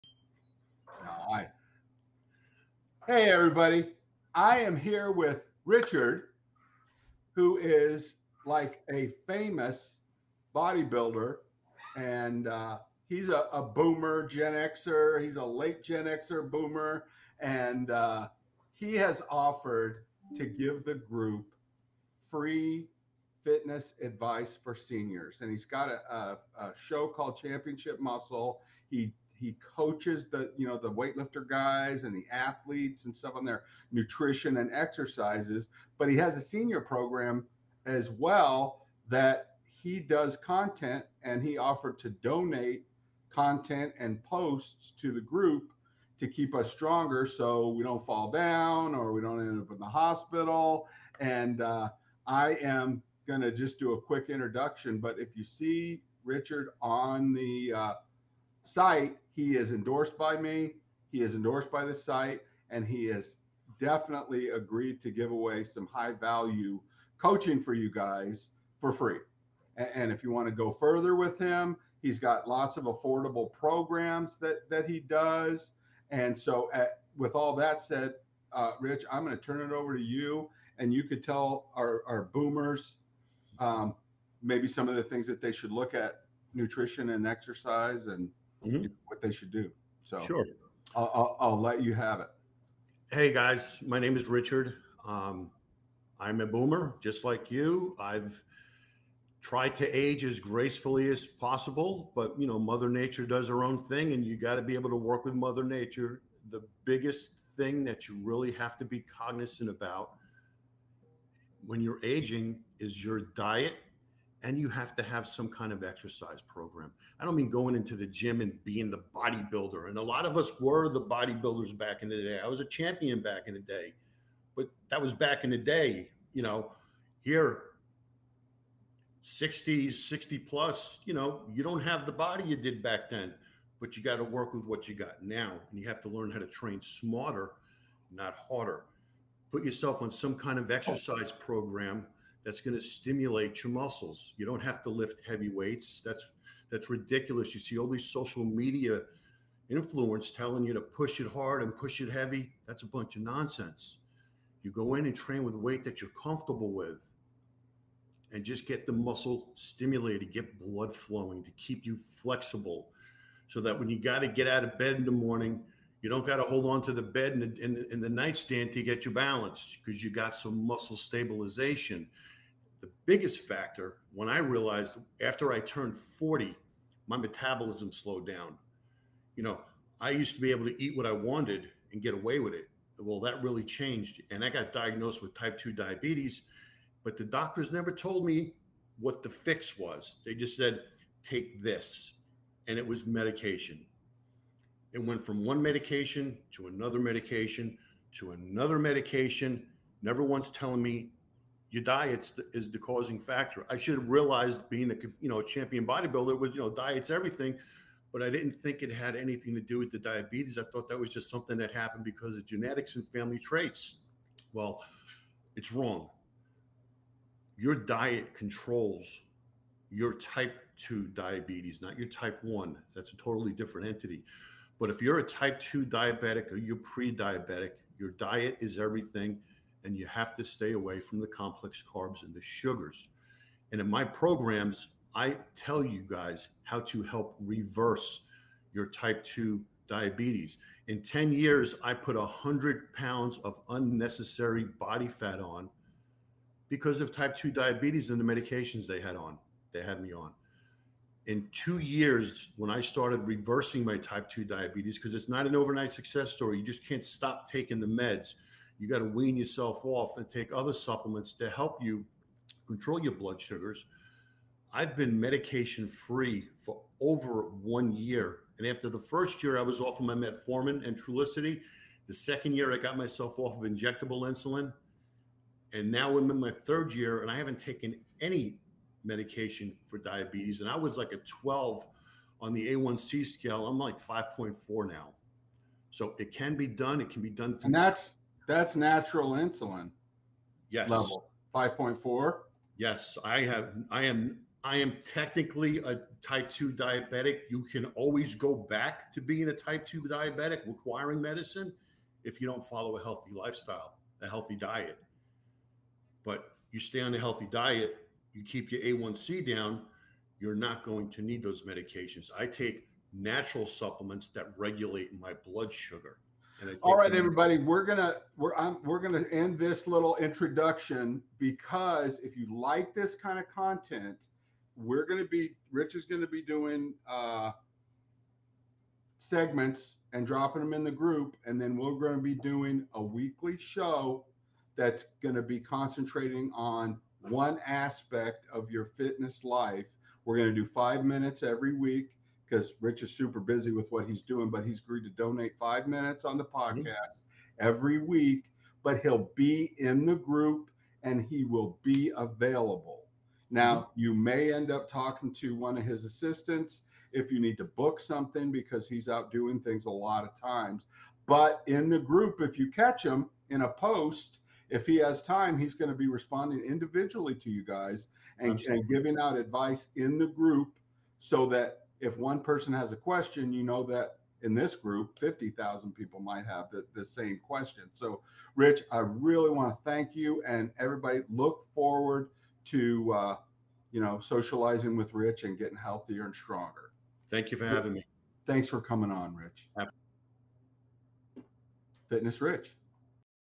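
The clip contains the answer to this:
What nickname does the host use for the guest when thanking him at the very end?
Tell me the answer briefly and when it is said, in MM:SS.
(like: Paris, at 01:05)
Fitness Rich, at 06:32.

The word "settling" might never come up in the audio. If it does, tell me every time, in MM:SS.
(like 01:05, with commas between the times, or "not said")
not said.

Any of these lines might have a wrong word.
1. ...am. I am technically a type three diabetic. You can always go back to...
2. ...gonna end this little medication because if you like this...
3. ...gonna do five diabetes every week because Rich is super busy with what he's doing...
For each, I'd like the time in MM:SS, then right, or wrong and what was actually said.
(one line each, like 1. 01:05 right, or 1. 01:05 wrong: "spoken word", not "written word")
1. 04:54 wrong: "two", not "three"
2. 05:18 wrong: "introduction", not "medication"
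3. 05:40 wrong: "minutes", not "diabetes".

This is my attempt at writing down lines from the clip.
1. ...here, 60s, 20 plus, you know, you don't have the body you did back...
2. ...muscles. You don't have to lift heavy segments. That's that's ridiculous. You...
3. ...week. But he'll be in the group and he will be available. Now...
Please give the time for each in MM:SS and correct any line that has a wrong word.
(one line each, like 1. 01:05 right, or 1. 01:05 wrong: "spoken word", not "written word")
1. 02:07 wrong: "60", not "20"
2. 02:23 wrong: "weights", not "segments"
3. 05:47 right.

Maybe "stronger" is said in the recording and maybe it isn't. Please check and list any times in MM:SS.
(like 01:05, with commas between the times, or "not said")
00:46, 06:26.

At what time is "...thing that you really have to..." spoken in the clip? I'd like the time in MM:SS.
01:47.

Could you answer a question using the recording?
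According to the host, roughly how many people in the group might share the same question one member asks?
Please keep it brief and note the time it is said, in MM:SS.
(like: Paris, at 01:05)
50,000, at 06:15.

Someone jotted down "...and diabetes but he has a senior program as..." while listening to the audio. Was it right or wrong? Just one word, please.
wrong.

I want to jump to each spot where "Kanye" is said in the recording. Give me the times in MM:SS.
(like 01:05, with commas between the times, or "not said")
not said.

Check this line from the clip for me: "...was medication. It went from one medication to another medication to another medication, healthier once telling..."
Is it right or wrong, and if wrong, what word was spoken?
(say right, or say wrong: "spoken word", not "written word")
wrong: "never", not "healthier".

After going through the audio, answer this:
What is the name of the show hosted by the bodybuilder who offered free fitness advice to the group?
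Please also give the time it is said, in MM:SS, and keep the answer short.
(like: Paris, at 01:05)
Championship Muscle, at 00:27.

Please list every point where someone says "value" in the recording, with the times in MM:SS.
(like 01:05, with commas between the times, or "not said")
01:06.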